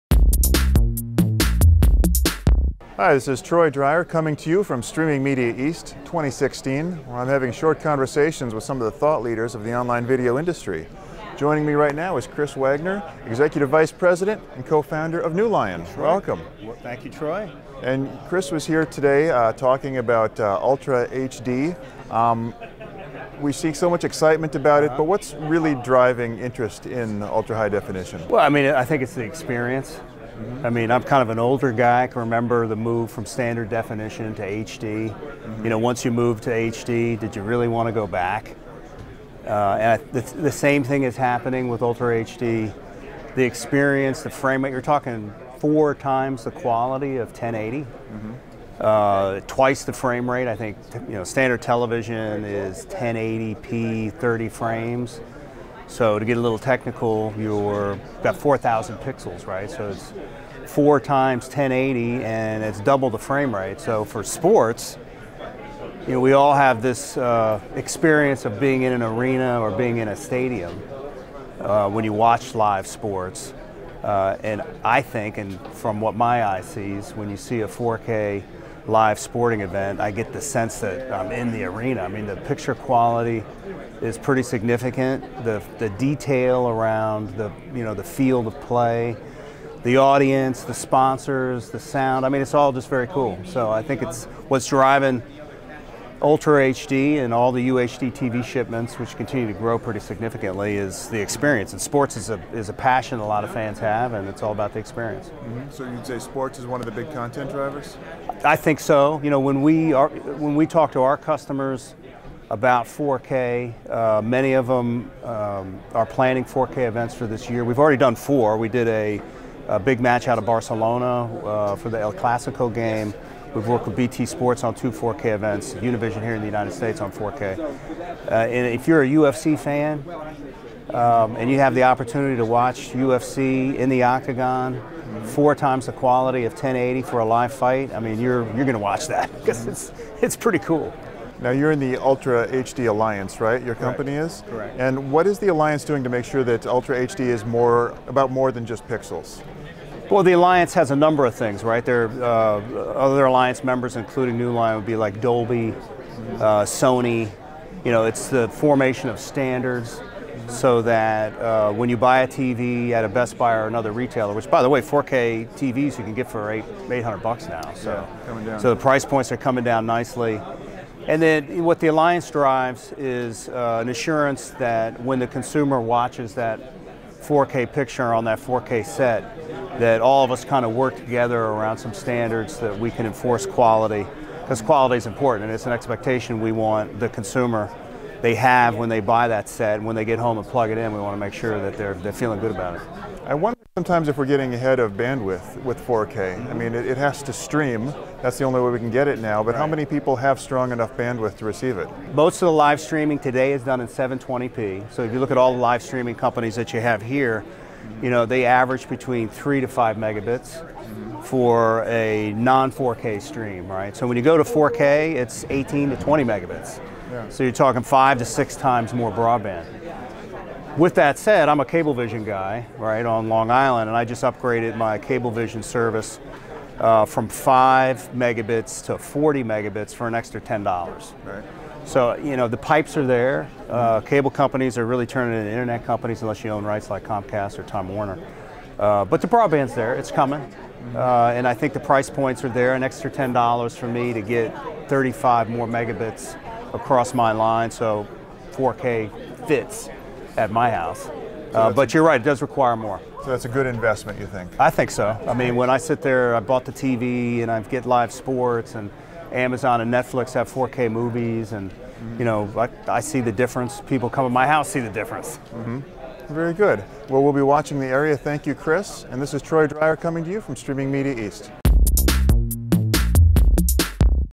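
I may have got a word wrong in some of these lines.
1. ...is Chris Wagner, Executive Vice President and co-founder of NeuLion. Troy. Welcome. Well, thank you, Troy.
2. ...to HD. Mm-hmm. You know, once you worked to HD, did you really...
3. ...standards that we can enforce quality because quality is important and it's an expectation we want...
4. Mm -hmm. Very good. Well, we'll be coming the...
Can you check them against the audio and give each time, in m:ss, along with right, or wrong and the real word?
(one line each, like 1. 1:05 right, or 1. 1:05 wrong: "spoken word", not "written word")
1. 0:12 right
2. 0:34 wrong: "moved", not "worked"
3. 3:01 right
4. 4:25 wrong: "watching", not "coming".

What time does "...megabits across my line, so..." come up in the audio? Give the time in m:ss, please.
4:05.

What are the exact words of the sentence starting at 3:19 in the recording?
how many people have strong enough bandwidth to receive it?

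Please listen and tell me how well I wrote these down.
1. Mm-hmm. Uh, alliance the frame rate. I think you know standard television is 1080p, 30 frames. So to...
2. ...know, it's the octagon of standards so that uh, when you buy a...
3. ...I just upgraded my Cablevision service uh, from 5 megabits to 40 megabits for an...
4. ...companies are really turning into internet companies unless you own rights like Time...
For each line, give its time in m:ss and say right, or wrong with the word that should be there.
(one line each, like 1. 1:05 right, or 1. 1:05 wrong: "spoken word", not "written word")
1. 0:47 wrong: "twice", not "alliance"
2. 2:37 wrong: "formation", not "octagon"
3. 3:43 right
4. 3:54 wrong: "Comcast", not "Time".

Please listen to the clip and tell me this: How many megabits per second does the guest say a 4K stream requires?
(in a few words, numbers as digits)
18 to 20 megabits.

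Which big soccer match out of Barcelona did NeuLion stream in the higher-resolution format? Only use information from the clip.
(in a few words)
El Clasico.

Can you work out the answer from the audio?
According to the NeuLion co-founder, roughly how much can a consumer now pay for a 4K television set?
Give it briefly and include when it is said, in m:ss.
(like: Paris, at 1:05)
$800, at 2:46.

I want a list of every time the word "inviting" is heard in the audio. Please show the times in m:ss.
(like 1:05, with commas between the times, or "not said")
not said.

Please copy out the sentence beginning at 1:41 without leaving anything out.
And sports is a, is a passion a lot of fans have, and it's all about the experience.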